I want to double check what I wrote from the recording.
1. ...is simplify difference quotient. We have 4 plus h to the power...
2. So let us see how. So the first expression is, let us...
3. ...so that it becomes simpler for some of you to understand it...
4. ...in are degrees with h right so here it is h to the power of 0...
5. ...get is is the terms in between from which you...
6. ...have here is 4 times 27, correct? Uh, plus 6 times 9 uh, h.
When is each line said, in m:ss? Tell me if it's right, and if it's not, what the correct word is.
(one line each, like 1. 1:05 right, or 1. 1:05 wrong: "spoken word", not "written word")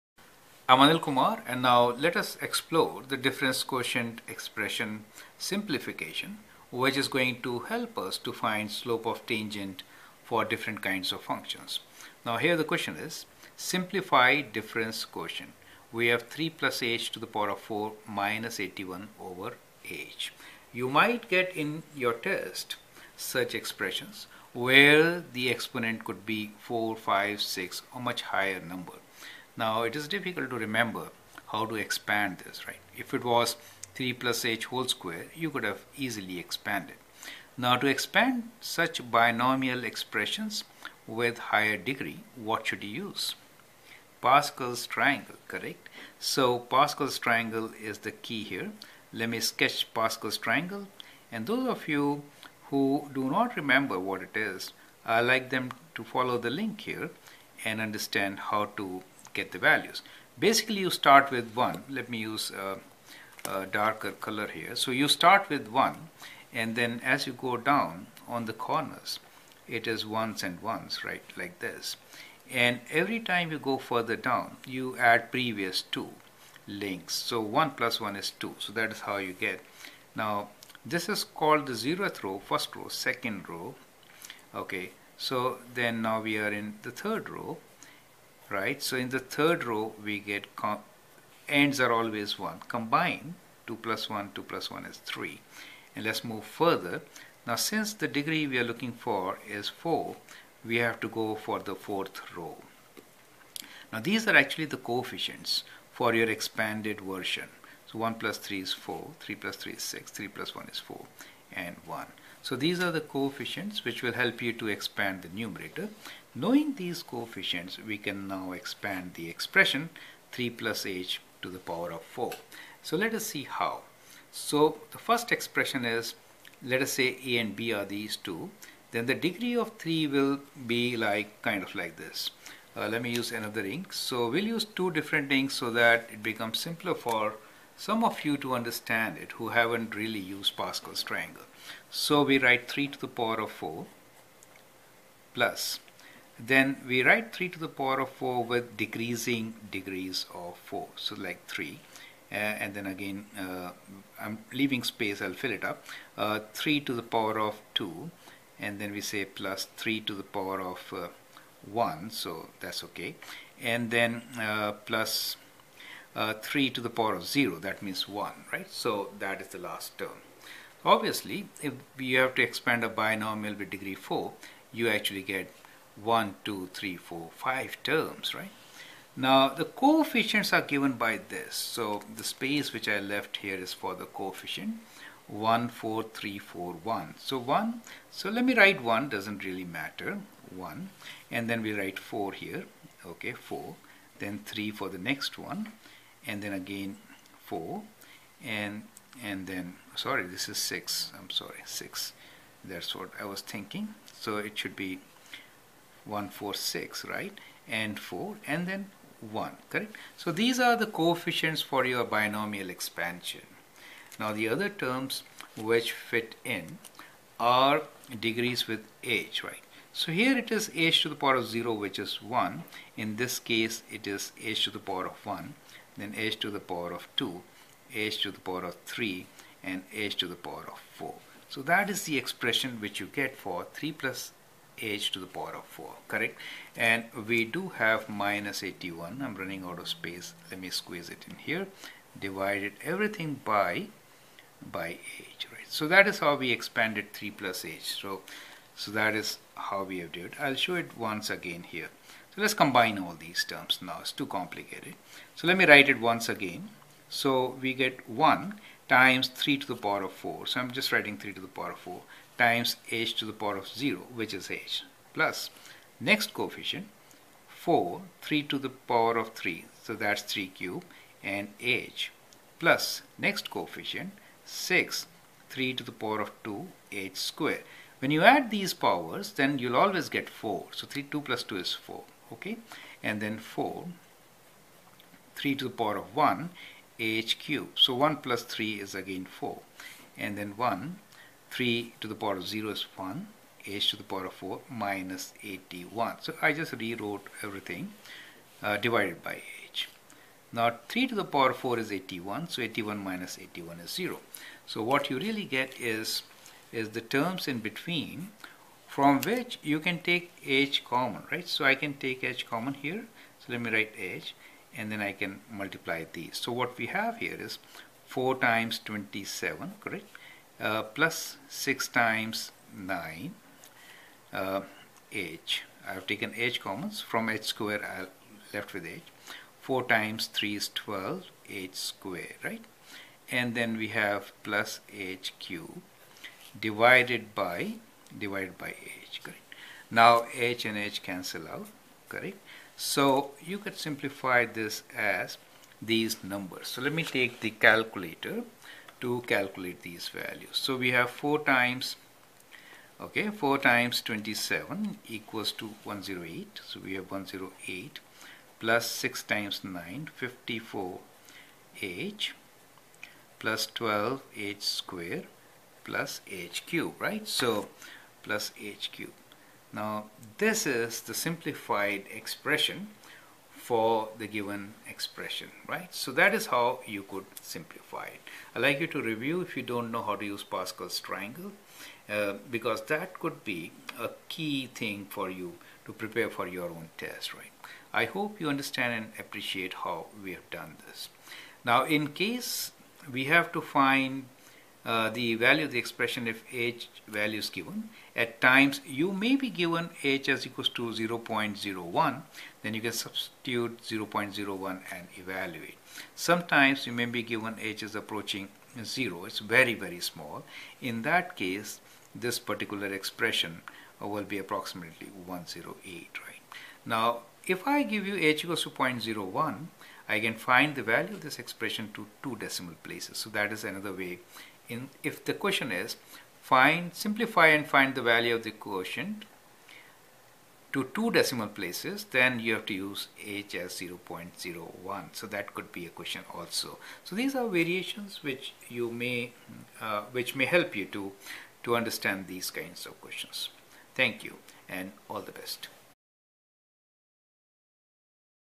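1. 0:12 wrong: "3", not "4"
2. 2:02 right
3. 2:15 right
4. 3:36 right
5. 5:05 right
6. 5:16 right.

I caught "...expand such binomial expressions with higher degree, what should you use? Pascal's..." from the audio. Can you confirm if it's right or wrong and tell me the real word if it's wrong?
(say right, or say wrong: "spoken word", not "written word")
right.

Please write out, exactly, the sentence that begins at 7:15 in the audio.
So that could be a question also.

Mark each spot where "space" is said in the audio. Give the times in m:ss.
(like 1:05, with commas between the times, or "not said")
2:34, 3:02, 3:59.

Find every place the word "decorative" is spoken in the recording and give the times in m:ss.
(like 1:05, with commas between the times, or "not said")
not said.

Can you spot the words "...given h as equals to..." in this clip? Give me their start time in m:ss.
6:39.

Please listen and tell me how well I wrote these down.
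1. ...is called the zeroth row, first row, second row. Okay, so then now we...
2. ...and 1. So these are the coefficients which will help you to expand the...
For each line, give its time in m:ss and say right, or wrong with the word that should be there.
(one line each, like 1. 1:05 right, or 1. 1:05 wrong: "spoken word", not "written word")
1. 1:21 right
2. 1:51 right.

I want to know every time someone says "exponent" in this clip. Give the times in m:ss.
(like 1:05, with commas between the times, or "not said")
0:25.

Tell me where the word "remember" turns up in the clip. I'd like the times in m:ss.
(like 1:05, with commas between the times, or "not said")
0:30, 0:53.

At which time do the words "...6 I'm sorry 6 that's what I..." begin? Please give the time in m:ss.
3:20.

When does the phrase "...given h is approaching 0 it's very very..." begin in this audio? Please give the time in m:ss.
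6:47.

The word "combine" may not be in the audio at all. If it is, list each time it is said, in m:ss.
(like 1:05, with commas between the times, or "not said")
1:32, 4:12.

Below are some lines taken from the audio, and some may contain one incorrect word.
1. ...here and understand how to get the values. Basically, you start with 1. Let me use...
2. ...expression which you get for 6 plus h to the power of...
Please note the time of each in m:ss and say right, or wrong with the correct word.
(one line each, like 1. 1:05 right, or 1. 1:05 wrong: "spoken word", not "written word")
1. 0:56 right
2. 3:52 wrong: "3", not "6".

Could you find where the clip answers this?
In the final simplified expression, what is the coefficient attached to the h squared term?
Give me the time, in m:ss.
6:03.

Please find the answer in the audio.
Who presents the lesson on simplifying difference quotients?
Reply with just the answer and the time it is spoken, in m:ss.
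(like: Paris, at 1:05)
Anil Kumar, at 0:00.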